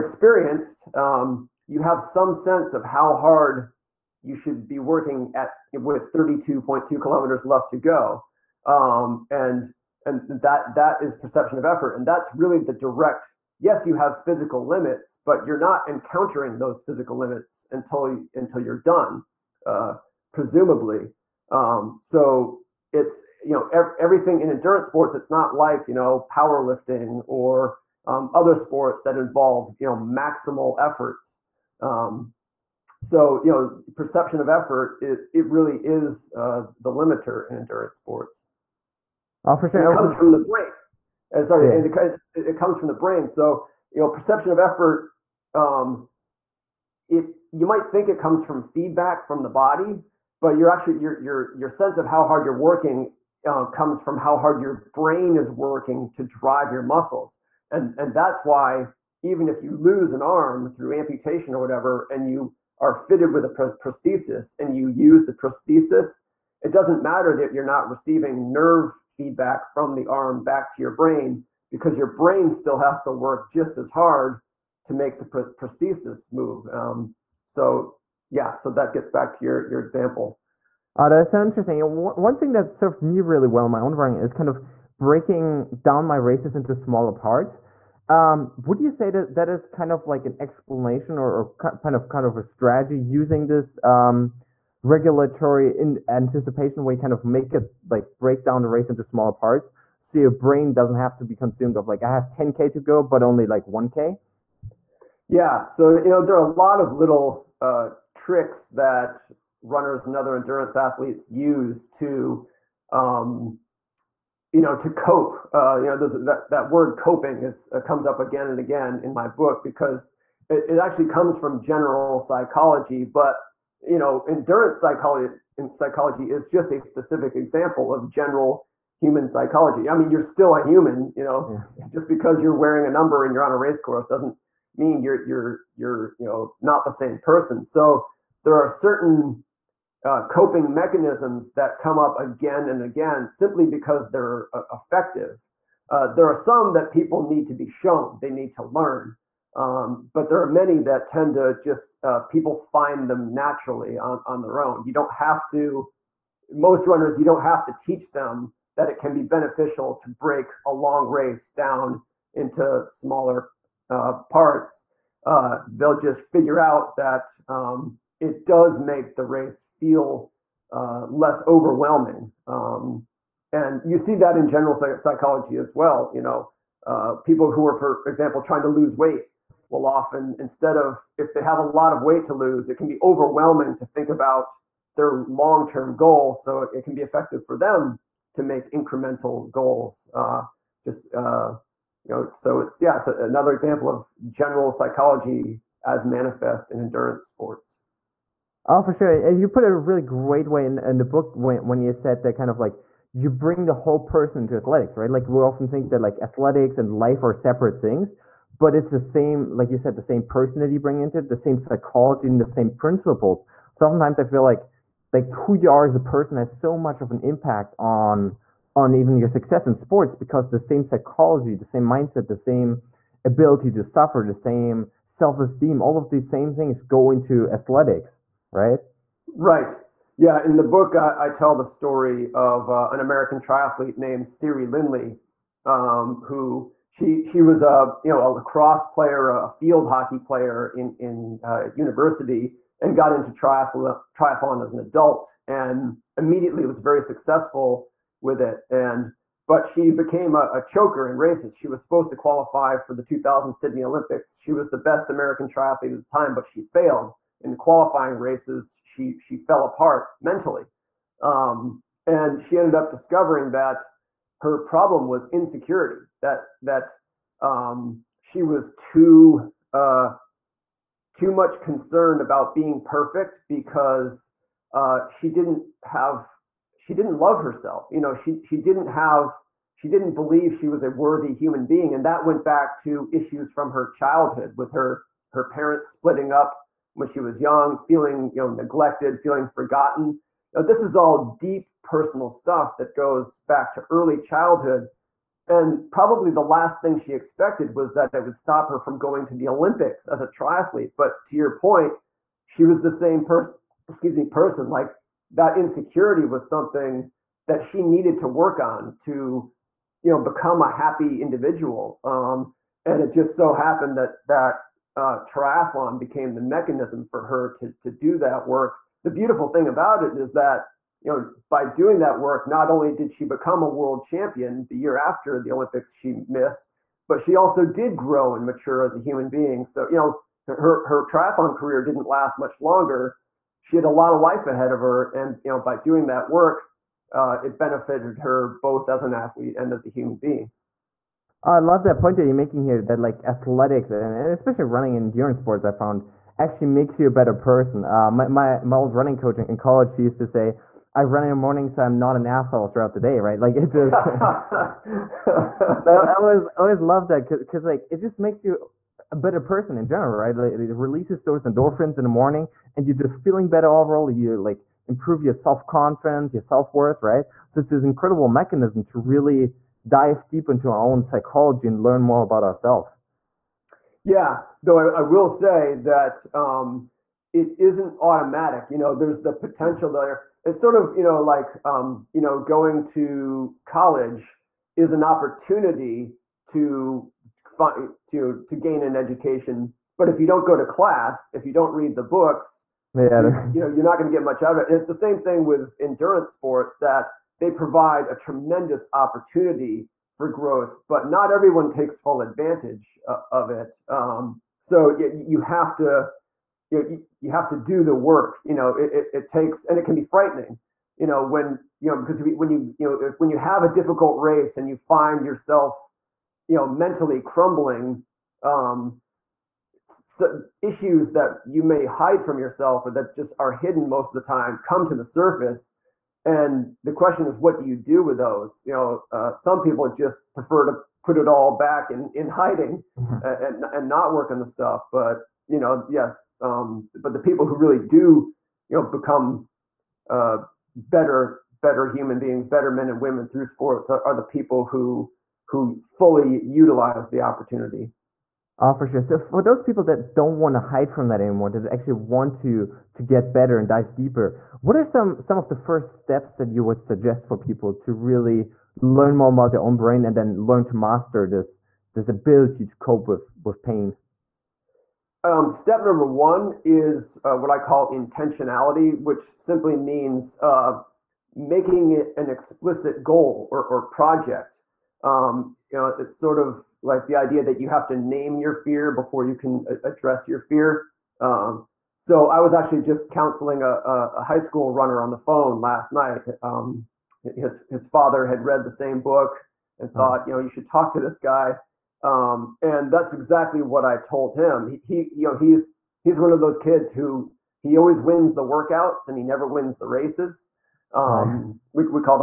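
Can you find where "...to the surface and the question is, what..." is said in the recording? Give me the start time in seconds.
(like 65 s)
424 s.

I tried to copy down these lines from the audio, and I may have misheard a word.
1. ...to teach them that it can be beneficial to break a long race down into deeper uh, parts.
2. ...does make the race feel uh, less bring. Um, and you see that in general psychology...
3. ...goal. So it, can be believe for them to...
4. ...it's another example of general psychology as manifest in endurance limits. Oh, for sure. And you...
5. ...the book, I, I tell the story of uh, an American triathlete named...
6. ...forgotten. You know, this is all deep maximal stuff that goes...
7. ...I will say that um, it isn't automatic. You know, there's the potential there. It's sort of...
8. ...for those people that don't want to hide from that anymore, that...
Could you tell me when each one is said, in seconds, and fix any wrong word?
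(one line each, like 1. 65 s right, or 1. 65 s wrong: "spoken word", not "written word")
1. 157 s wrong: "smaller", not "deeper"
2. 168 s wrong: "overwhelming", not "bring"
3. 185 s wrong: "effective", not "believe"
4. 192 s wrong: "sports", not "limits"
5. 230 s right
6. 289 s wrong: "personal", not "maximal"
7. 375 s right
8. 449 s right.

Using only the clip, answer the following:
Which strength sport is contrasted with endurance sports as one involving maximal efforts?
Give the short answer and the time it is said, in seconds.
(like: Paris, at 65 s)
Powerlifting, at 26 s.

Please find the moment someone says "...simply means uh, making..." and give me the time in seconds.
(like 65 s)
469 s.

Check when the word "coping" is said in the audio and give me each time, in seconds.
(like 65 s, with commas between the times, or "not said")
116 s, 140 s.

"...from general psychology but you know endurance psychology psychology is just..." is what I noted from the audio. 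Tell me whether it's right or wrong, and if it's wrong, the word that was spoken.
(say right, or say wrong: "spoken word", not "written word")
right.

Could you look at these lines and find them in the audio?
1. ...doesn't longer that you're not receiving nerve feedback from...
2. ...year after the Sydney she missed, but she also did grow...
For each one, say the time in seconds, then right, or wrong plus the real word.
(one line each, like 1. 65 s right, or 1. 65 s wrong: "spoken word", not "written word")
1. 66 s wrong: "matter", not "longer"
2. 324 s wrong: "Olympics", not "Sydney".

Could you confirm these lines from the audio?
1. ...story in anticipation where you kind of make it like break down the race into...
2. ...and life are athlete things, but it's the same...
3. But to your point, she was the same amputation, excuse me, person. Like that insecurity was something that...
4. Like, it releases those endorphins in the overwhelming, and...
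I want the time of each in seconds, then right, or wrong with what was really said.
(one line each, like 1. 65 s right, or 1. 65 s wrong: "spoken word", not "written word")
1. 94 s wrong: "regulatory", not "story"
2. 206 s wrong: "separate", not "athlete"
3. 300 s wrong: "person", not "amputation"
4. 360 s wrong: "morning", not "overwhelming".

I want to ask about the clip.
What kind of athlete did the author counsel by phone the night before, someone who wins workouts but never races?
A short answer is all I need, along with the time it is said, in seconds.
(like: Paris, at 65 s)
High school runner, at 484 s.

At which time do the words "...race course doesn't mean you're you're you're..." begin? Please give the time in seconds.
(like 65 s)
133 s.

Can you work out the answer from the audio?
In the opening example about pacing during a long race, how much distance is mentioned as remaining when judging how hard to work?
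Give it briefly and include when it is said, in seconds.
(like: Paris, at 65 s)
32.2 kilometers, at 6 s.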